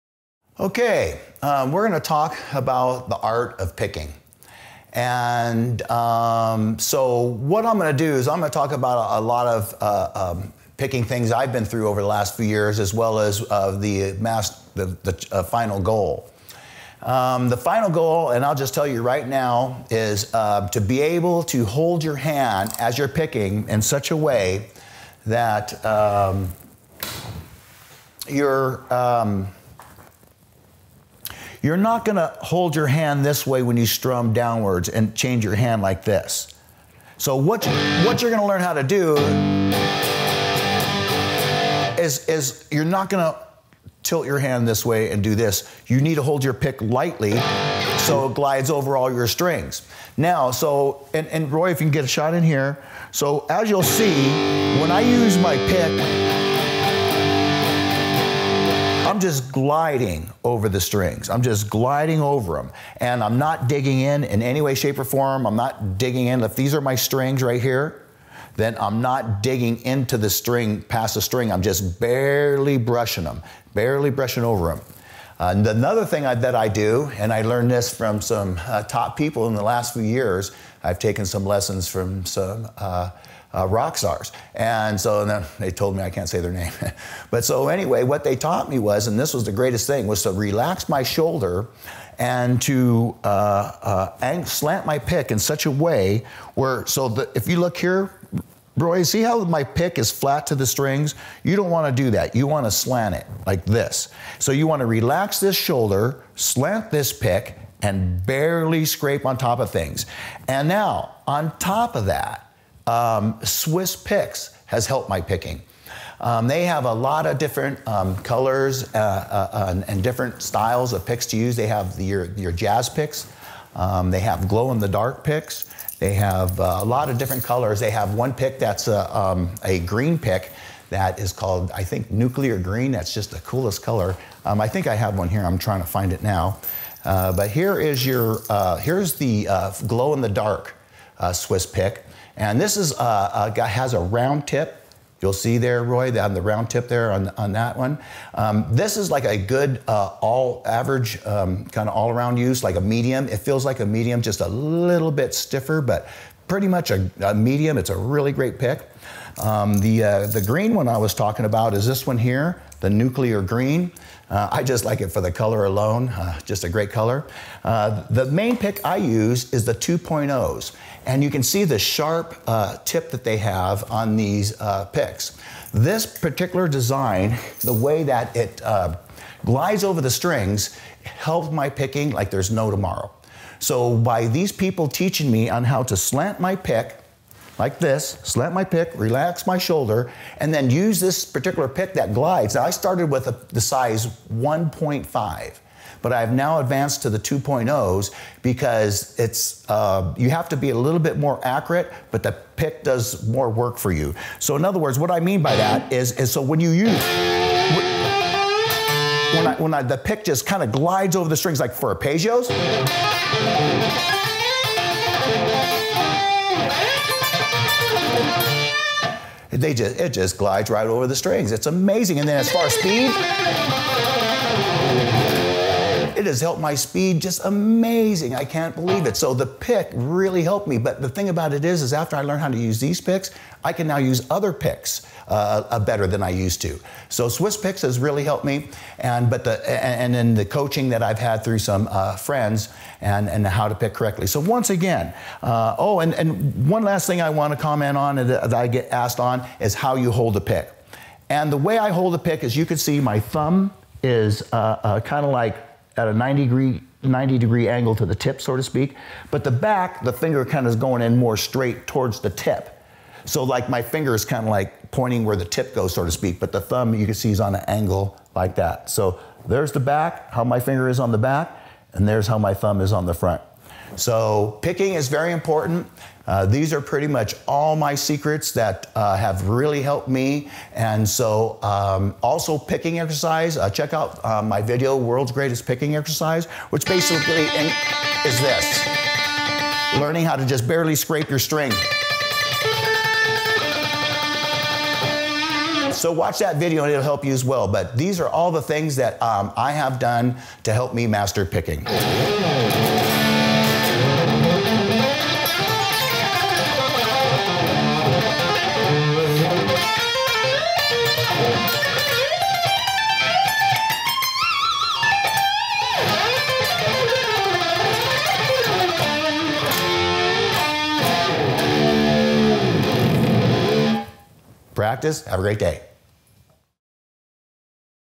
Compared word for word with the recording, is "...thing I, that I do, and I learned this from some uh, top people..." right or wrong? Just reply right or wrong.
right.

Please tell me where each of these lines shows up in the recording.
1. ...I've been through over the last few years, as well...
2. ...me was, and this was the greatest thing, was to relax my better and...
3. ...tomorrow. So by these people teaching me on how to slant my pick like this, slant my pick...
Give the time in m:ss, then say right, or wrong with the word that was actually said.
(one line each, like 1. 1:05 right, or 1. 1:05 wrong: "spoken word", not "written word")
1. 0:11 right
2. 1:28 wrong: "shoulder", not "better"
3. 3:02 right.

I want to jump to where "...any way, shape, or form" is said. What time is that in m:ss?
1:04.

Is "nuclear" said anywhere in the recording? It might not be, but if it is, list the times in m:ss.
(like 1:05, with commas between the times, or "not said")
2:12, 2:42.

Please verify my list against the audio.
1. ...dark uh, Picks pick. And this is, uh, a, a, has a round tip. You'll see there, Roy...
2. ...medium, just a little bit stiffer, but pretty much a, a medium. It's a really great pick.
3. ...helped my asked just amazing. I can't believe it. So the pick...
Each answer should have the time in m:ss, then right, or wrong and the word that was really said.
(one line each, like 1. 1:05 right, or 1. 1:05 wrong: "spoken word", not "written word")
1. 2:20 wrong: "Swiss", not "Picks"
2. 2:33 right
3. 3:46 wrong: "speed", not "asked".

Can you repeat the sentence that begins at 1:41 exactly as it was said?
You don't want to do that.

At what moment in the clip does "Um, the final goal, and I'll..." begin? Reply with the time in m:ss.
0:17.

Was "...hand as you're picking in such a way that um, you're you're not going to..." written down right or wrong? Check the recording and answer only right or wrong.
right.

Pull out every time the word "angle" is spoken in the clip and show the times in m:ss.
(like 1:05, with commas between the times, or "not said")
4:17, 4:27.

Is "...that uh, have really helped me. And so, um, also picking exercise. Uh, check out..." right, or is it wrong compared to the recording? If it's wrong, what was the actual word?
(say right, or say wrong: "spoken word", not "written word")
right.